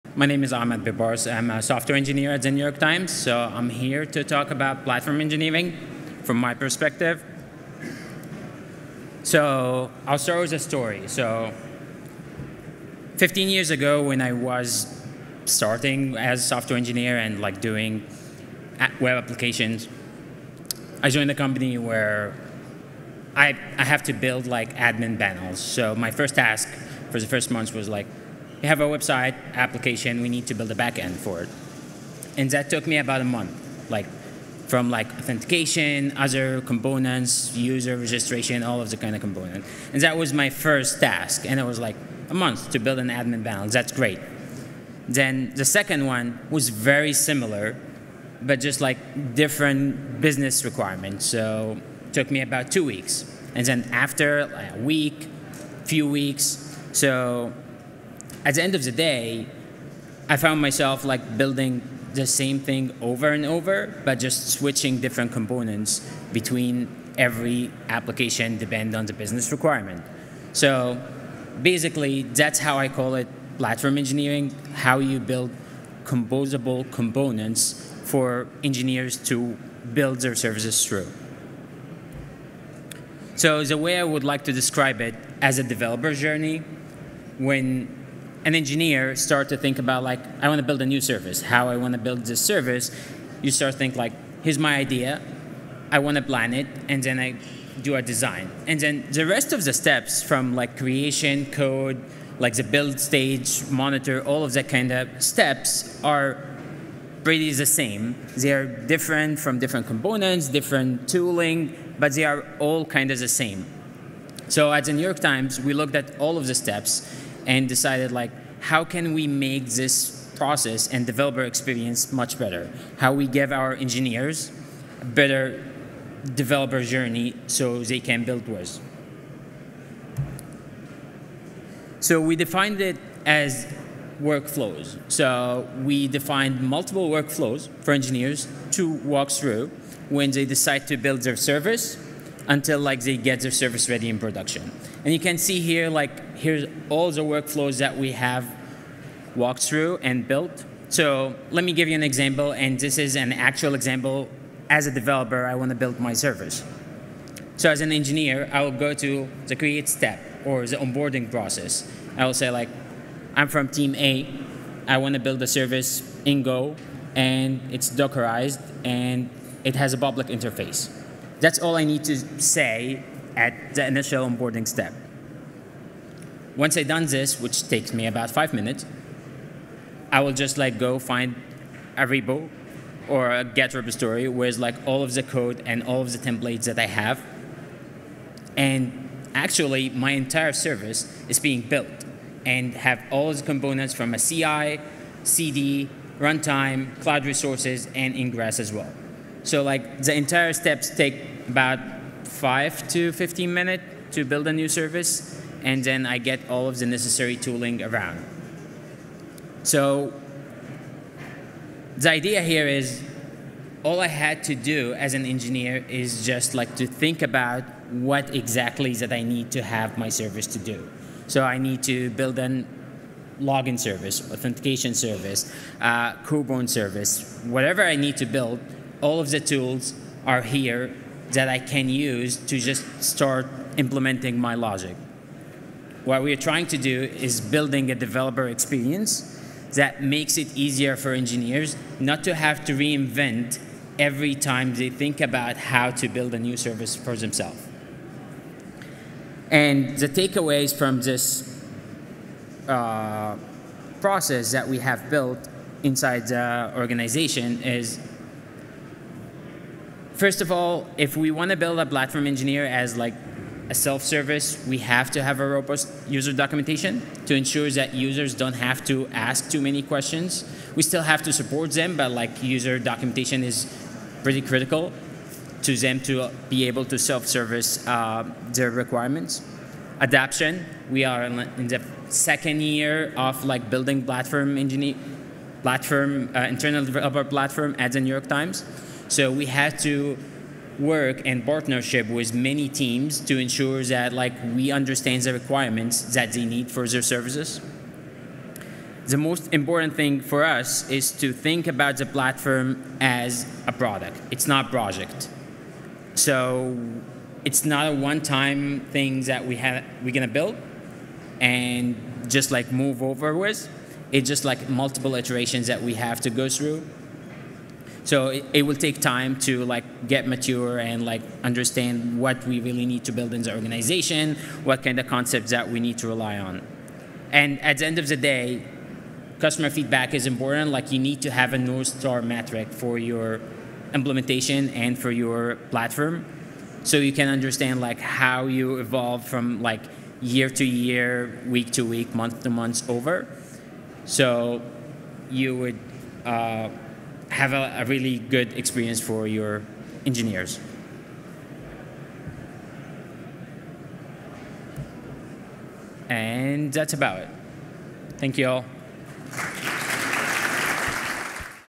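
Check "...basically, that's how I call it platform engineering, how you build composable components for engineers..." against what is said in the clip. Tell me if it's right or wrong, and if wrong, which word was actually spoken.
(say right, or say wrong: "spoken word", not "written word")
right.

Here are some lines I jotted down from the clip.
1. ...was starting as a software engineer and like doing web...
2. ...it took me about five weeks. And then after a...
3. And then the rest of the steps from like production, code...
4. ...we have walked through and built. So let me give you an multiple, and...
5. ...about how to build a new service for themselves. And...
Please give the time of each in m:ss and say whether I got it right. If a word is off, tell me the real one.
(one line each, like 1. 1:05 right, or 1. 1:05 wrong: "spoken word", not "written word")
1. 0:14 right
2. 0:52 wrong: "two", not "five"
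3. 1:38 wrong: "creation", not "production"
4. 2:27 wrong: "example", not "multiple"
5. 4:05 right.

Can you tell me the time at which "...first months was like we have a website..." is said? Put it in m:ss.
0:27.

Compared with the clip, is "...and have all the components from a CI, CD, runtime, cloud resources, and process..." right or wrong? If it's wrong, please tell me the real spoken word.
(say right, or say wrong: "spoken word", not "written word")
wrong: "ingress", not "process".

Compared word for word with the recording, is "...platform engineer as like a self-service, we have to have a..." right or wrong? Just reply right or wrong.
right.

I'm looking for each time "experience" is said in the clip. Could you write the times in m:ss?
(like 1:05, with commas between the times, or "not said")
2:01, 3:58, 5:48.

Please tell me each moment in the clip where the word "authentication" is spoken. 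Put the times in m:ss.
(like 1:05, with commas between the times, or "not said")
0:35, 3:44.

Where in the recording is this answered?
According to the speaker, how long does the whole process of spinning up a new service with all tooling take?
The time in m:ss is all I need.
3:22.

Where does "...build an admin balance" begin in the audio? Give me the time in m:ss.
0:42.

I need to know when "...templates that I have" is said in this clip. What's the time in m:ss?
3:06.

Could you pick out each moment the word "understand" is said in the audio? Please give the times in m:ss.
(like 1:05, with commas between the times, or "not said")
4:54, 5:21, 5:37.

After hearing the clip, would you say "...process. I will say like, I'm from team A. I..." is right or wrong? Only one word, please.
right.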